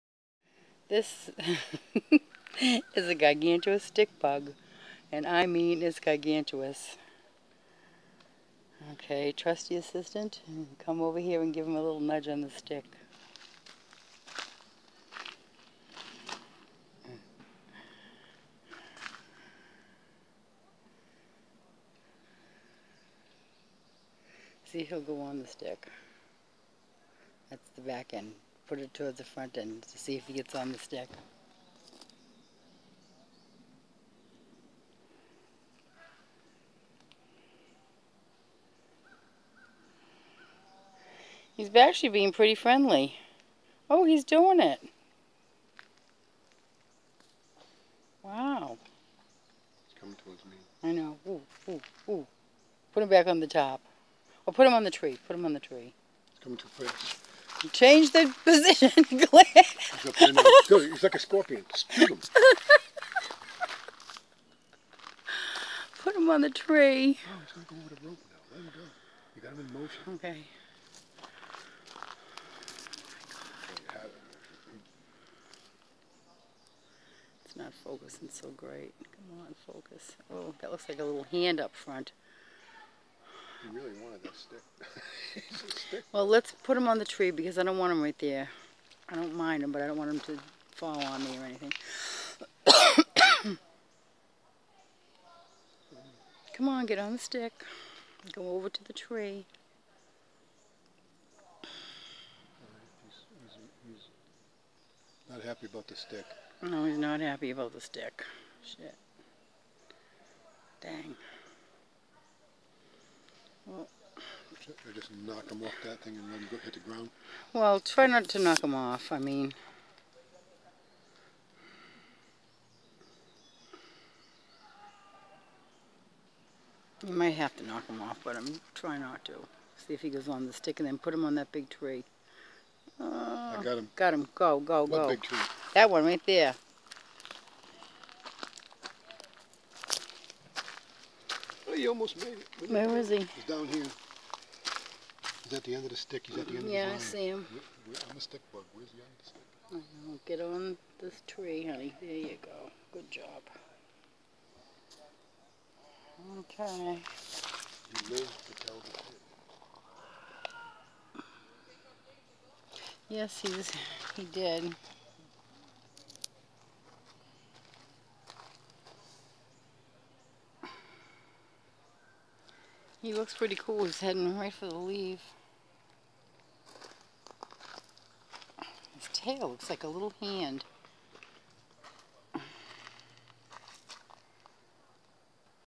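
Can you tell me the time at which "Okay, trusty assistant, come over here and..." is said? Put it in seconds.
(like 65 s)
8 s.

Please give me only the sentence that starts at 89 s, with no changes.
I don't mind them, but I don't want them to fall on me or anything.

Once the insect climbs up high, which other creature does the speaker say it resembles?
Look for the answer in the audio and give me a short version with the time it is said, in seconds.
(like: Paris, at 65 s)
scorpion, at 61 s.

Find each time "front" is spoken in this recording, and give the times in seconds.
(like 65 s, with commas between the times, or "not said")
29 s, 81 s.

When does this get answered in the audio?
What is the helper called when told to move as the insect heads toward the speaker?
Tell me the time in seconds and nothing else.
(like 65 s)
59 s.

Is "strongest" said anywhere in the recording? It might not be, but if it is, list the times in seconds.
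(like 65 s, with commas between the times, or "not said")
not said.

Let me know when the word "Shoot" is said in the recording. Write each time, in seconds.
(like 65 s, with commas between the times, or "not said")
61 s.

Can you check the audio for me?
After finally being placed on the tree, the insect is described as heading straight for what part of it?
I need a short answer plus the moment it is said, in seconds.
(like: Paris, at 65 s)
the leaf, at 174 s.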